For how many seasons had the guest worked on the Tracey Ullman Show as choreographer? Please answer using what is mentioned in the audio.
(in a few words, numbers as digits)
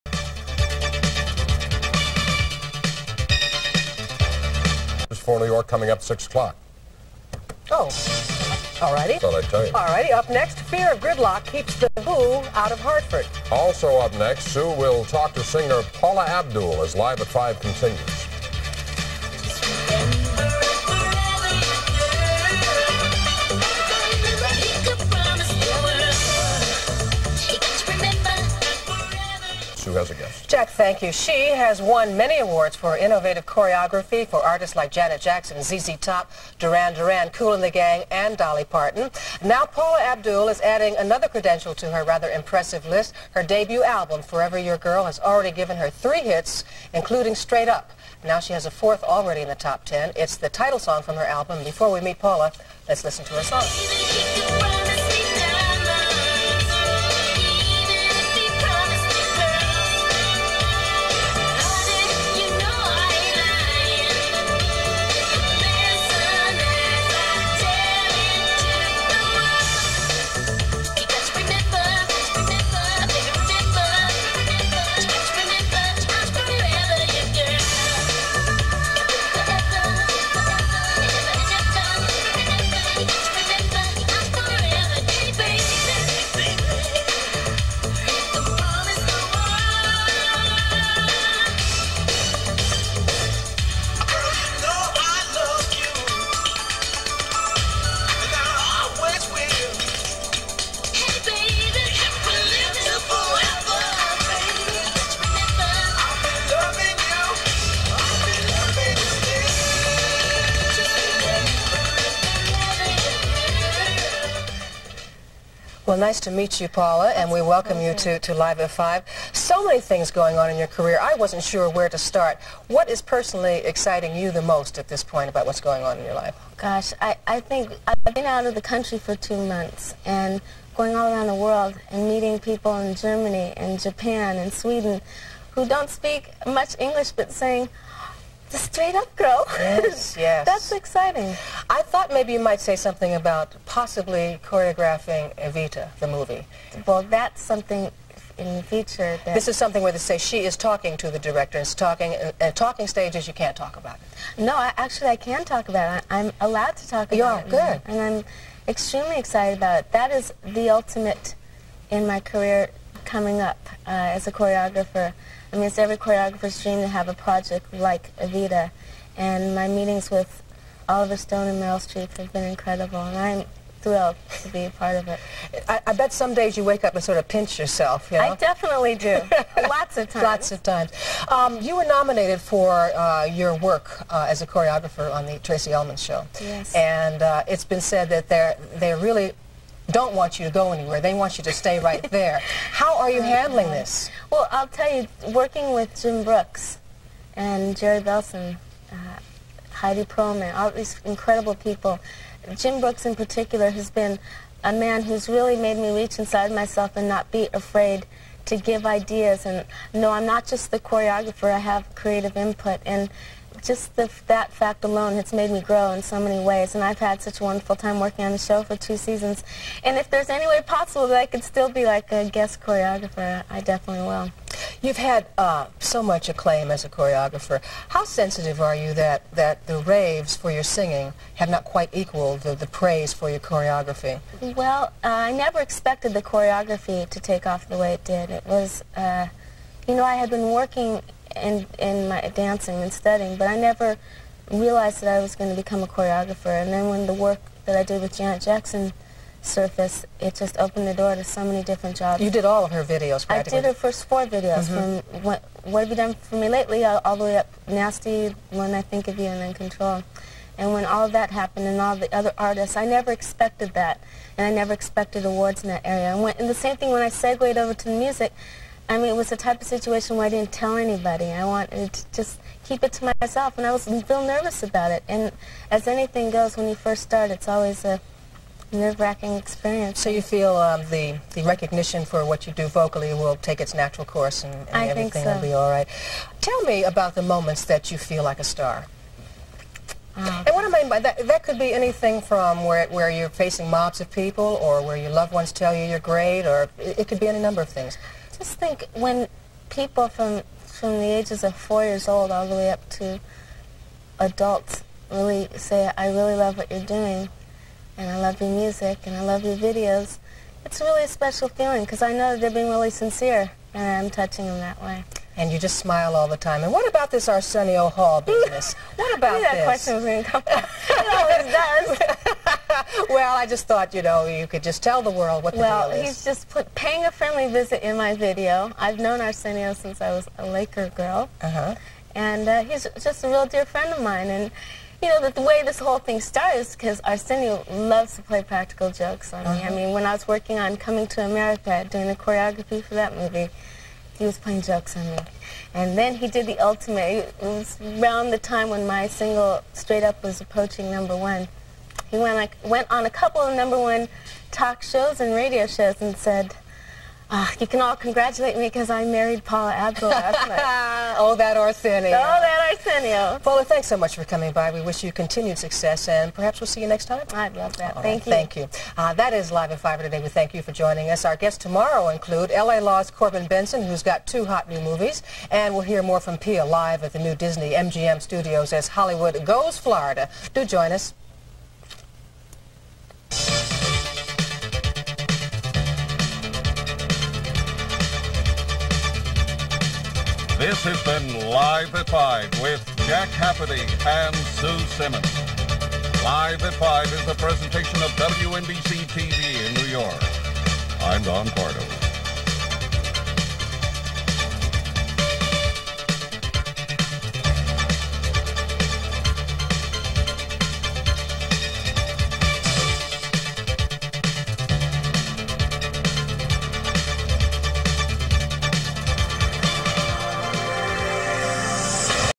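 2.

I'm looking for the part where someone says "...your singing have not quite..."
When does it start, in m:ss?
3:50.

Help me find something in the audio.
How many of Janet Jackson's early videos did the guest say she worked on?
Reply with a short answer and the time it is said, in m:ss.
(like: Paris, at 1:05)
4, at 4:13.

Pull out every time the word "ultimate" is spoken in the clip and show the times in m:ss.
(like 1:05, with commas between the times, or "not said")
2:40, 5:46.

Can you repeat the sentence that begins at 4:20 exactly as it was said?
And when all that happened and all the other artists, I never expected that.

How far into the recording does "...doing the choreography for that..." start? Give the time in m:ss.
5:41.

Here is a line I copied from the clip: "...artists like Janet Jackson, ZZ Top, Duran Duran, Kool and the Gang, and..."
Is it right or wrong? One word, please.
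right.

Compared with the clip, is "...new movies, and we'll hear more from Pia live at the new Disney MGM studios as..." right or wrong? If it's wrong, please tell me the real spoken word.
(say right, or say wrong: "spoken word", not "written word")
right.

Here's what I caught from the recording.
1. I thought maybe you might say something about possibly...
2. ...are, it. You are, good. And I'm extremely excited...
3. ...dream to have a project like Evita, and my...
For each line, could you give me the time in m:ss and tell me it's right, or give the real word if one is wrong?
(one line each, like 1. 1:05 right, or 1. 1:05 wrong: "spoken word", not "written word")
1. 2:21 right
2. 2:37 right
3. 2:46 right.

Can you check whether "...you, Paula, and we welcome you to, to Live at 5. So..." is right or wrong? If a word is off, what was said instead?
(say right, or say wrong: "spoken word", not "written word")
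right.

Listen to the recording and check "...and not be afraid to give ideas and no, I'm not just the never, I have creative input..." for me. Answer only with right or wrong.
wrong.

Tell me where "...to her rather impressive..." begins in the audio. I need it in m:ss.
0:41.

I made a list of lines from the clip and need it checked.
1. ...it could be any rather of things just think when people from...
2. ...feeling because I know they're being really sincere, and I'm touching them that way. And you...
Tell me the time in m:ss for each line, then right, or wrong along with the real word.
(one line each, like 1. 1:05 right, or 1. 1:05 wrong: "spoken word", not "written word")
1. 4:56 wrong: "number", not "rather"
2. 5:11 right.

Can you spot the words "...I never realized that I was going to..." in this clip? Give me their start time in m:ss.
4:03.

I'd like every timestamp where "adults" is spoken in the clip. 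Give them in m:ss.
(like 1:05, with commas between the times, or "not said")
5:04.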